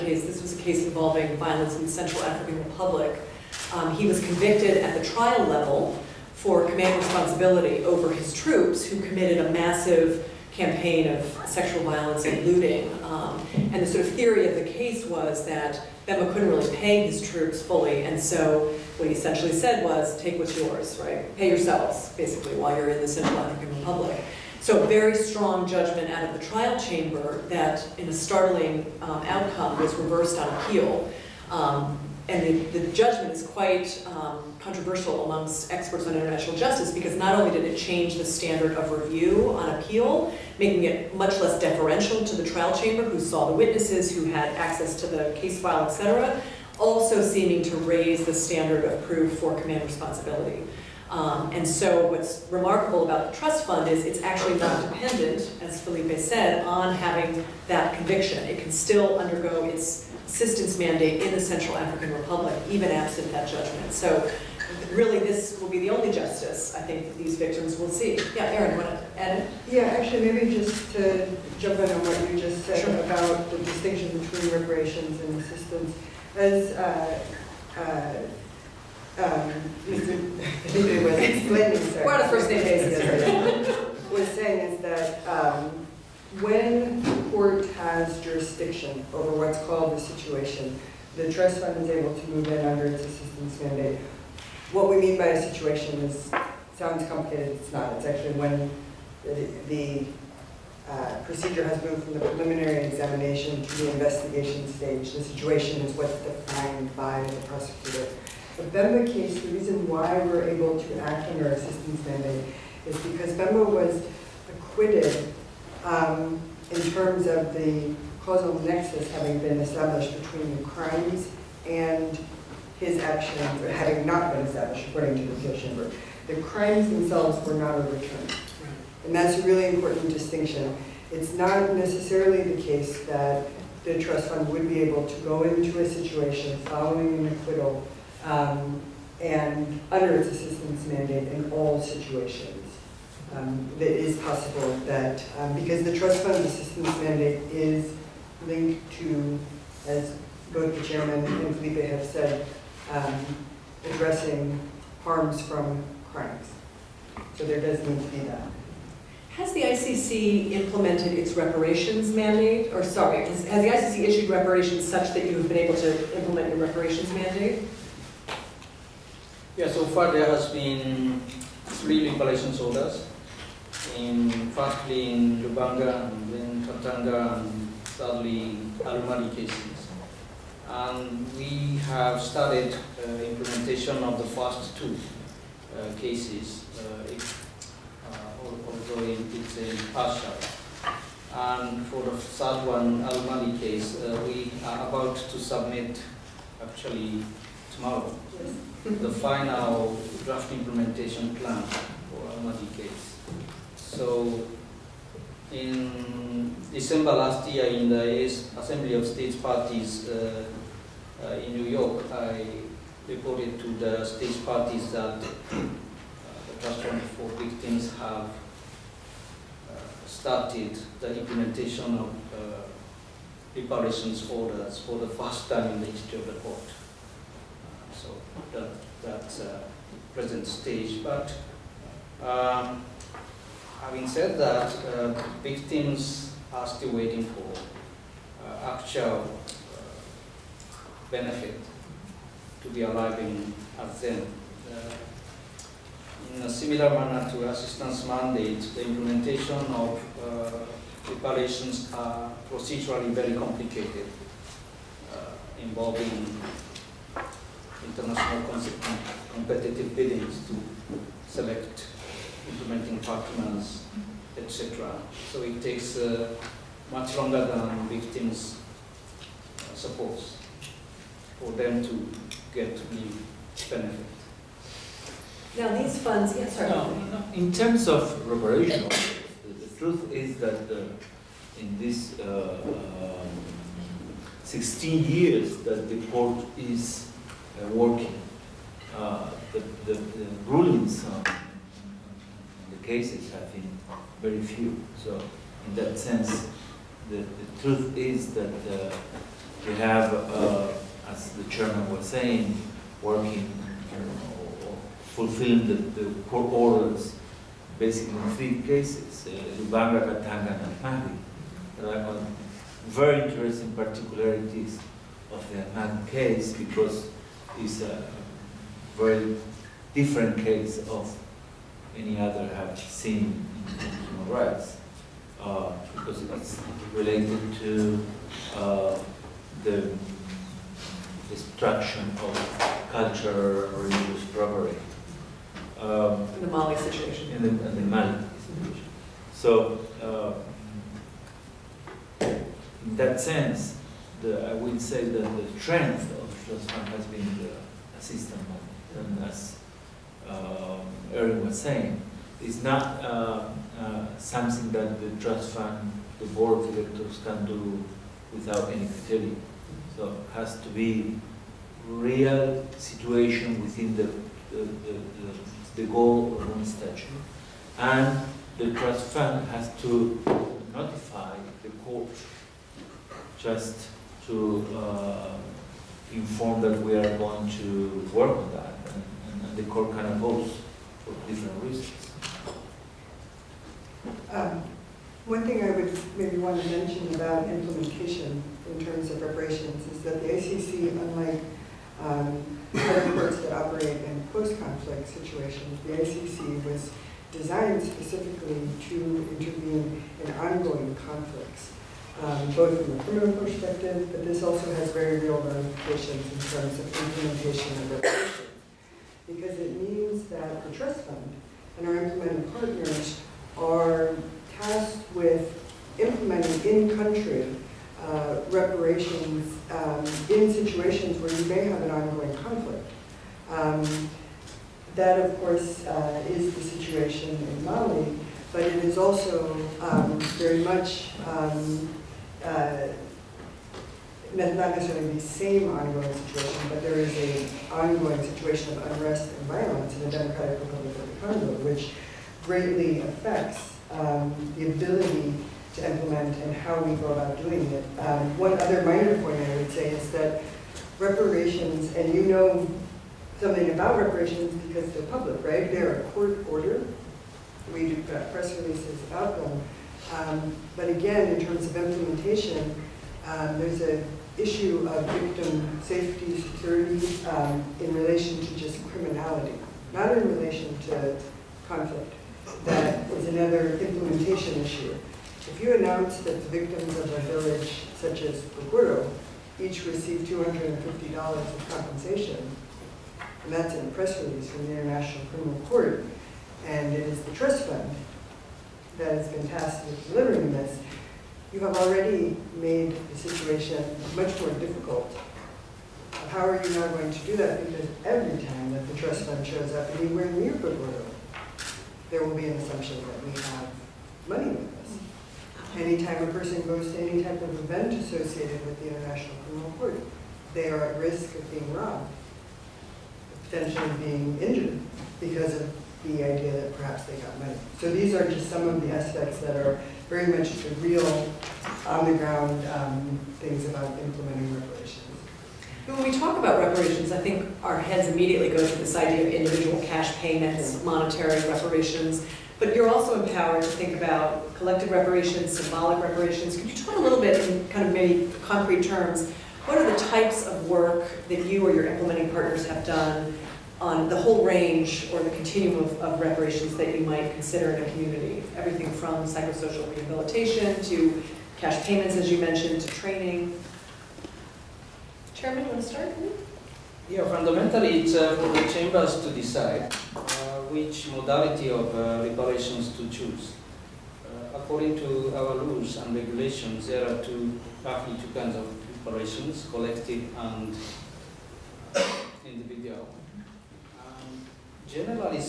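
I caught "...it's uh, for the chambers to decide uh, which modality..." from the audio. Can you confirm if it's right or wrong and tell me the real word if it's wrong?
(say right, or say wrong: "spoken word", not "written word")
right.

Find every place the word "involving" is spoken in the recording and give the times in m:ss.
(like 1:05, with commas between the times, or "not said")
0:00, 4:15.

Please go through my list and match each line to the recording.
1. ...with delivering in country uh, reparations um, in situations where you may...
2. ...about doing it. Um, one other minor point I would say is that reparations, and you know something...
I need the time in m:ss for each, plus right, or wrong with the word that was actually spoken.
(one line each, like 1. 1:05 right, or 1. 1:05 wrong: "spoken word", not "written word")
1. 6:55 wrong: "implementing", not "delivering"
2. 7:27 right.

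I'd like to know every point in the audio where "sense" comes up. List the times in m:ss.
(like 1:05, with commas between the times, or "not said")
4:55, 5:43.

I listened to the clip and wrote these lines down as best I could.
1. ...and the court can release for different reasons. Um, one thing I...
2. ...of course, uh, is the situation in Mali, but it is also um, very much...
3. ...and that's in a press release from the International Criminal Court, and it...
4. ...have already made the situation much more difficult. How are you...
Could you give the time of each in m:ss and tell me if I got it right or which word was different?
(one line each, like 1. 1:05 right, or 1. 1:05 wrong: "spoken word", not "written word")
1. 6:19 wrong: "oppose", not "release"
2. 7:05 right
3. 8:03 right
4. 8:11 right.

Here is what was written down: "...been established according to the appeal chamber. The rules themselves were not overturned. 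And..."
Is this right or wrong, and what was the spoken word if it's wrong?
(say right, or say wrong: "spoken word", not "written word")
wrong: "crimes", not "rules".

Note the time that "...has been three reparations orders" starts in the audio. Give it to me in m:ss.
2:50.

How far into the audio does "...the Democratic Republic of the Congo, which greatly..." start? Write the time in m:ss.
7:20.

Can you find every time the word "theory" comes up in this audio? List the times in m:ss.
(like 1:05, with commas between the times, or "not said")
0:14.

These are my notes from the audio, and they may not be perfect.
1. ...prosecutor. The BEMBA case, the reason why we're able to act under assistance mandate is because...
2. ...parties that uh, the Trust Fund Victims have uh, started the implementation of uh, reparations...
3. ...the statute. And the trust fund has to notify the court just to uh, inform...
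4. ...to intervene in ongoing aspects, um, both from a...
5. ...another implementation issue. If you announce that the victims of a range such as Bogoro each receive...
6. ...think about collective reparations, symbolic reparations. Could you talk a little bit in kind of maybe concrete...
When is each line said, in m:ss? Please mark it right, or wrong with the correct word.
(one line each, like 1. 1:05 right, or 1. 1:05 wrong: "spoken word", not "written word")
1. 1:47 right
2. 3:34 right
3. 6:06 right
4. 6:38 wrong: "conflicts", not "aspects"
5. 7:53 wrong: "village", not "range"
6. 8:53 right.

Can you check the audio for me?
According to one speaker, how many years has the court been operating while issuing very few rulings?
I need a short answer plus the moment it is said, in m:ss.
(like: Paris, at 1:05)
16, at 4:44.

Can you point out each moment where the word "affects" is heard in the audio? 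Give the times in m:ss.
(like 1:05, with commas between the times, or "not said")
7:23.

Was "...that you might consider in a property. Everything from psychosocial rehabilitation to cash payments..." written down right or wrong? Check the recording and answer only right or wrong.
wrong.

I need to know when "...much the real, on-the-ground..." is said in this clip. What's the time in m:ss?
8:40.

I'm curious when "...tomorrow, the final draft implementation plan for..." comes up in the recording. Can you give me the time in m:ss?
3:17.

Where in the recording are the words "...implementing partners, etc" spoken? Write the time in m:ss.
4:22.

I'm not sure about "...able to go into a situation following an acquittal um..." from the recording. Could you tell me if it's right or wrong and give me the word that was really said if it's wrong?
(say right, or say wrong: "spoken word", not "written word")
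right.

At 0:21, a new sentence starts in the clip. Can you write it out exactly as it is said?
Pay yourselves, basically, while you're in the Central African Republic.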